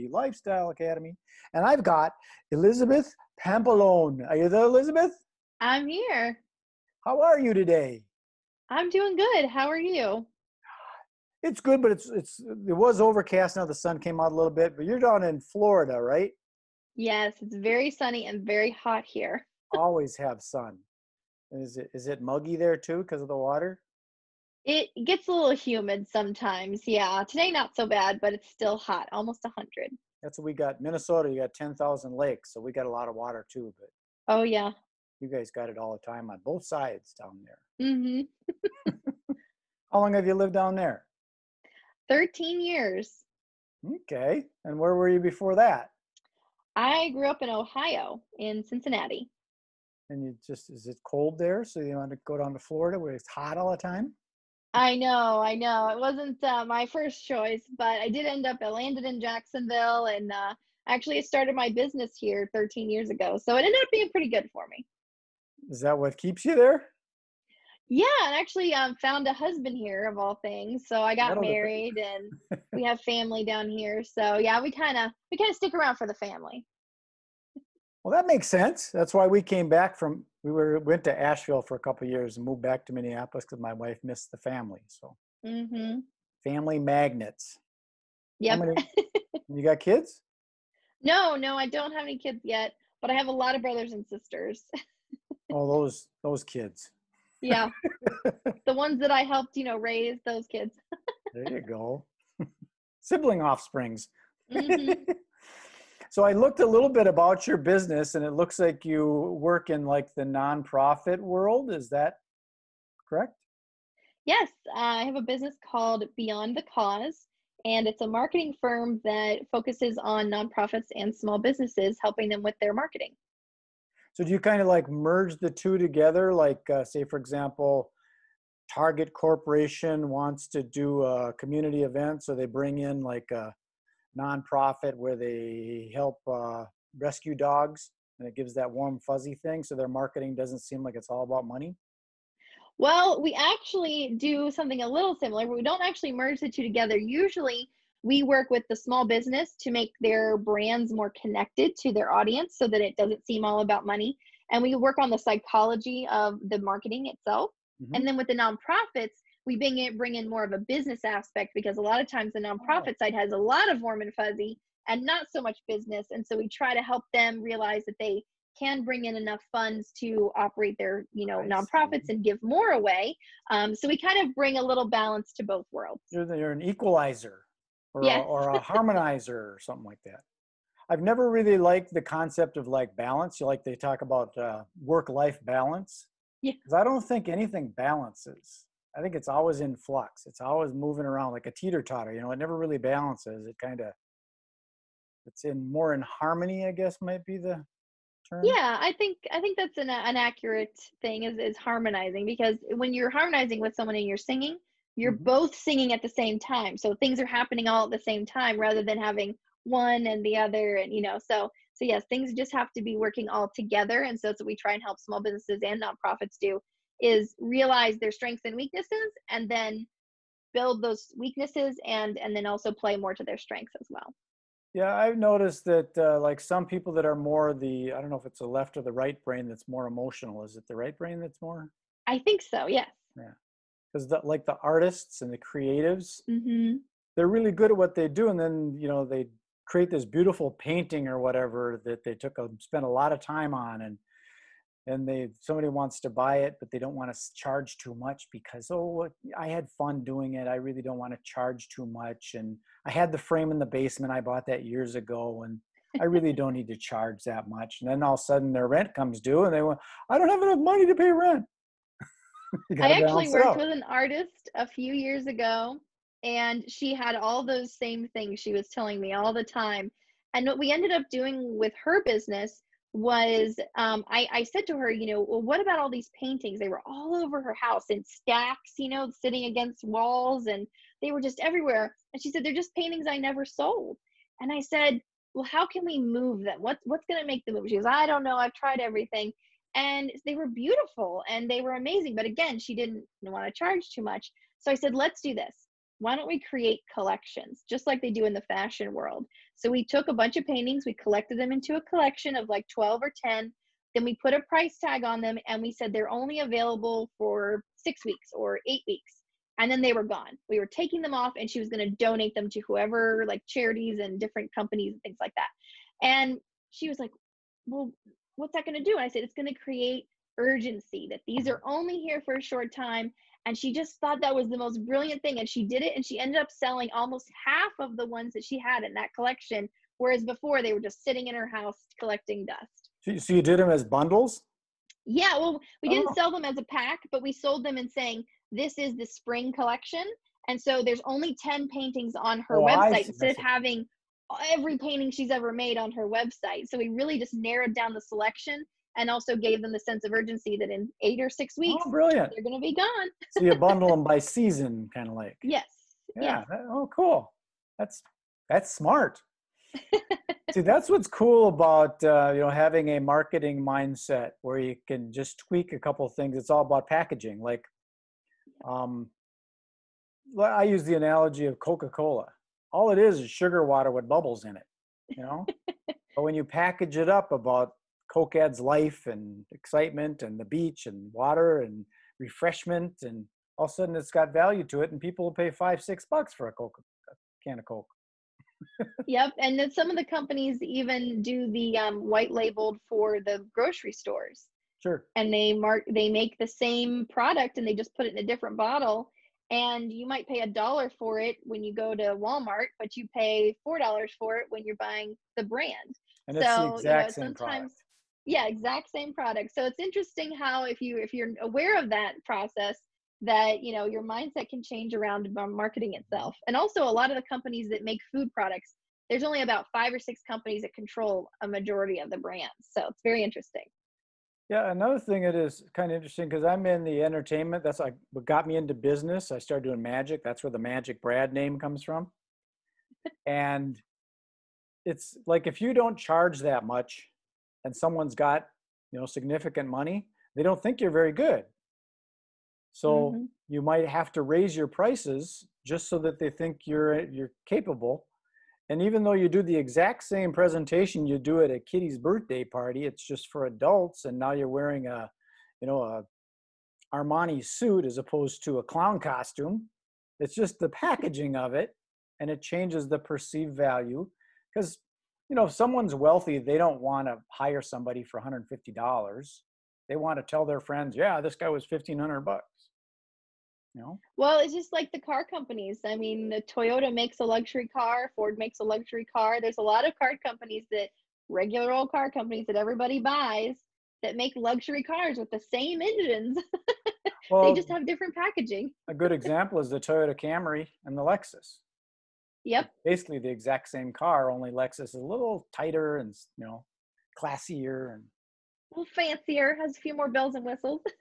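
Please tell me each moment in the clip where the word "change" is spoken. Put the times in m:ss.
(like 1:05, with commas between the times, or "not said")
6:54, 7:42.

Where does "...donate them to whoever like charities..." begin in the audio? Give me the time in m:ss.
5:11.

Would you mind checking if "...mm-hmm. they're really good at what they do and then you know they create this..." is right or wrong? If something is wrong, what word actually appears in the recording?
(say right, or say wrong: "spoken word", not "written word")
right.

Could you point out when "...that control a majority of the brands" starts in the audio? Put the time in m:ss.
7:00.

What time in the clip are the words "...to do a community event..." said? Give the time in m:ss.
2:10.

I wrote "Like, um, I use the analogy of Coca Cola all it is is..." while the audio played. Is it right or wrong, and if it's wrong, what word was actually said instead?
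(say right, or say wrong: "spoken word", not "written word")
right.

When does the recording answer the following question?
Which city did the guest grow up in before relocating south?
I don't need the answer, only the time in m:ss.
0:48.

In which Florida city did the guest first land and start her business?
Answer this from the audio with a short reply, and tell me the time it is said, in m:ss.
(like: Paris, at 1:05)
Jacksonville, at 0:59.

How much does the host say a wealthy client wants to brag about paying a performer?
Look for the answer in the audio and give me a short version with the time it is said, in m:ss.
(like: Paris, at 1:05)
$1500, at 7:51.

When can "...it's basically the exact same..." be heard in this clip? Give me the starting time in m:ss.
8:12.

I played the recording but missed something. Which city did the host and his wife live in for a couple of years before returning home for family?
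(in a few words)
Asheville.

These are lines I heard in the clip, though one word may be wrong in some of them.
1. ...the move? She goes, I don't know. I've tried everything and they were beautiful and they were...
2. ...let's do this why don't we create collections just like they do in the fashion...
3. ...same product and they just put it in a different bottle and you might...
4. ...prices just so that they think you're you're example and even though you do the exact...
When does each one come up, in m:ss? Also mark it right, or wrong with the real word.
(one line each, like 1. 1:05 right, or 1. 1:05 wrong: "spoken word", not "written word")
1. 4:47 right
2. 4:54 right
3. 6:36 right
4. 7:24 wrong: "capable", not "example".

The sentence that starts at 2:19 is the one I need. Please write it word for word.
So their marketing doesn't seem like it's all about money.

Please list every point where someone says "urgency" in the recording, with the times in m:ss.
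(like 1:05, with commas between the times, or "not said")
5:20, 5:50.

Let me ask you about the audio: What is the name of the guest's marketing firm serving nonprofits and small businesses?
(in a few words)
Beyond the Cause.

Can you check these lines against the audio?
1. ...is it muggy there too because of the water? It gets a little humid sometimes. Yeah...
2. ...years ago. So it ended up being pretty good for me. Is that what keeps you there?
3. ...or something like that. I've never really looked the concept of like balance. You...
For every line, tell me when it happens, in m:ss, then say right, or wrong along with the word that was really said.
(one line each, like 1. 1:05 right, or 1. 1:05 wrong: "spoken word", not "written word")
1. 0:21 right
2. 1:02 right
3. 2:59 wrong: "liked", not "looked".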